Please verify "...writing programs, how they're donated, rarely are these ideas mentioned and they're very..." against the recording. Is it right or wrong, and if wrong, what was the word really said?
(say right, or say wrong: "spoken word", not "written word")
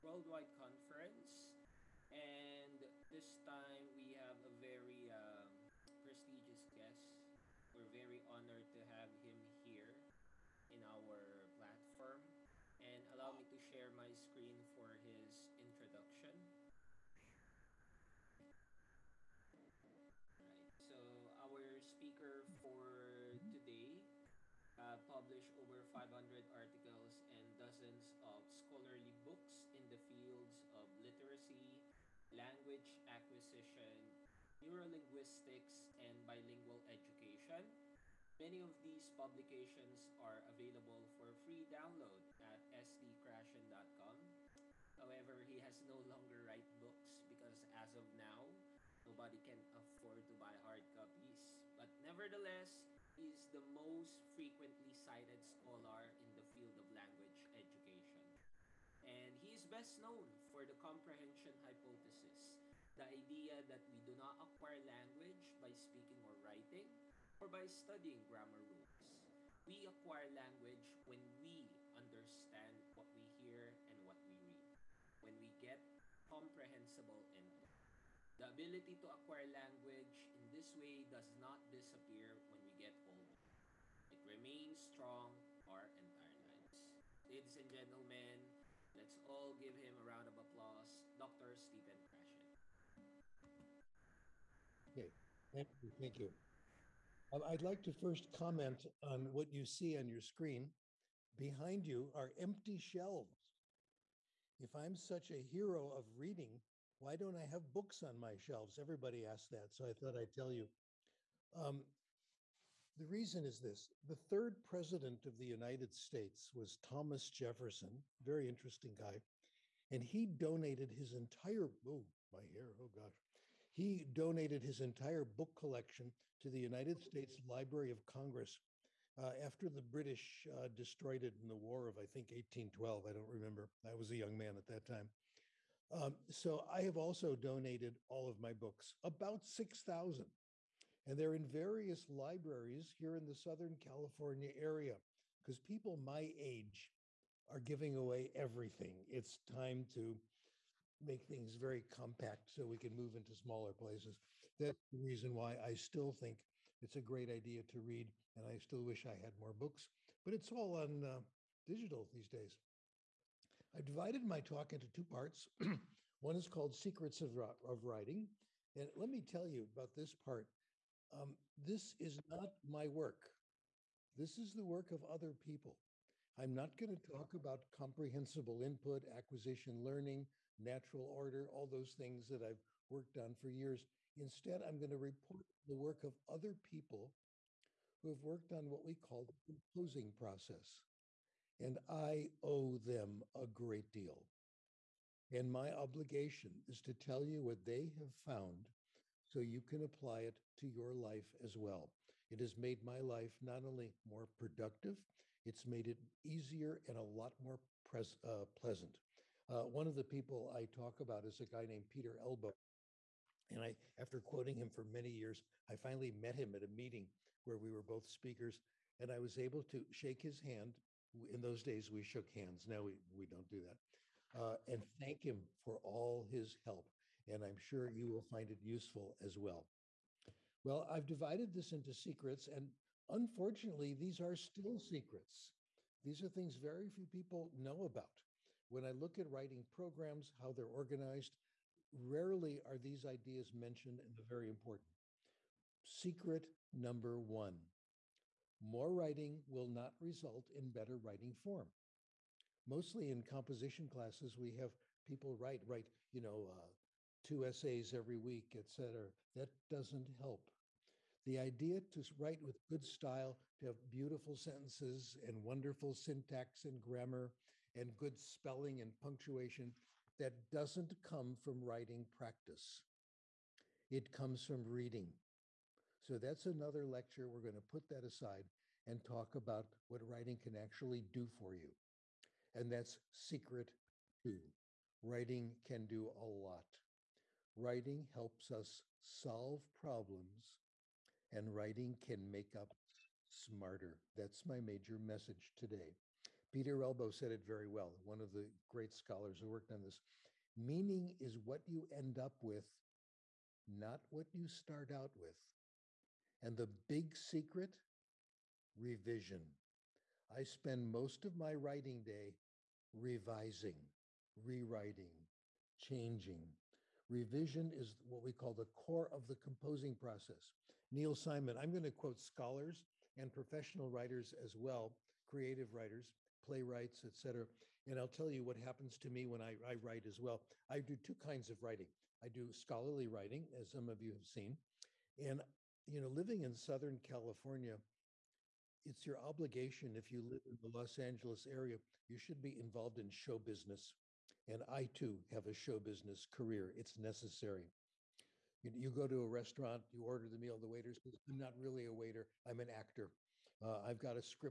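wrong: "organized", not "donated".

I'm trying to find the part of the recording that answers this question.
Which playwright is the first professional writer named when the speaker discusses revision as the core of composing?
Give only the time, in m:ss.
5:20.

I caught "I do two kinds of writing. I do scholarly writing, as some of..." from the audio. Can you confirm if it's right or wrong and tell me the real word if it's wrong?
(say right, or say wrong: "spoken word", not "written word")
right.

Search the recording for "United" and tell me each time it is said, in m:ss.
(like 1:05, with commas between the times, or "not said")
1:55, 2:06.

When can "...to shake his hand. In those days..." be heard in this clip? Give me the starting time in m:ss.
3:39.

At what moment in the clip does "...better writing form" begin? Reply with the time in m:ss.
4:10.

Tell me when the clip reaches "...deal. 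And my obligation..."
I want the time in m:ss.
3:13.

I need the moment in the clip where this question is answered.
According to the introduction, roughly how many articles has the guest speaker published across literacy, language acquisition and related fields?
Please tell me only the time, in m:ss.
0:25.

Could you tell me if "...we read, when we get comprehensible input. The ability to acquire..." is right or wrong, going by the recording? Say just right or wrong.
right.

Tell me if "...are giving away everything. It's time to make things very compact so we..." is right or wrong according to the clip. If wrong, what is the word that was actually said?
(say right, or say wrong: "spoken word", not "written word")
right.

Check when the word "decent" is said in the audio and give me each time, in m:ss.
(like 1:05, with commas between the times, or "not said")
not said.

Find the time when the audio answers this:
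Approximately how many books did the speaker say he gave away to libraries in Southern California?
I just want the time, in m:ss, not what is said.
2:19.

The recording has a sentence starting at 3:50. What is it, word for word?
Well, I've divided this into secrets, and unfortunately, these are still secrets.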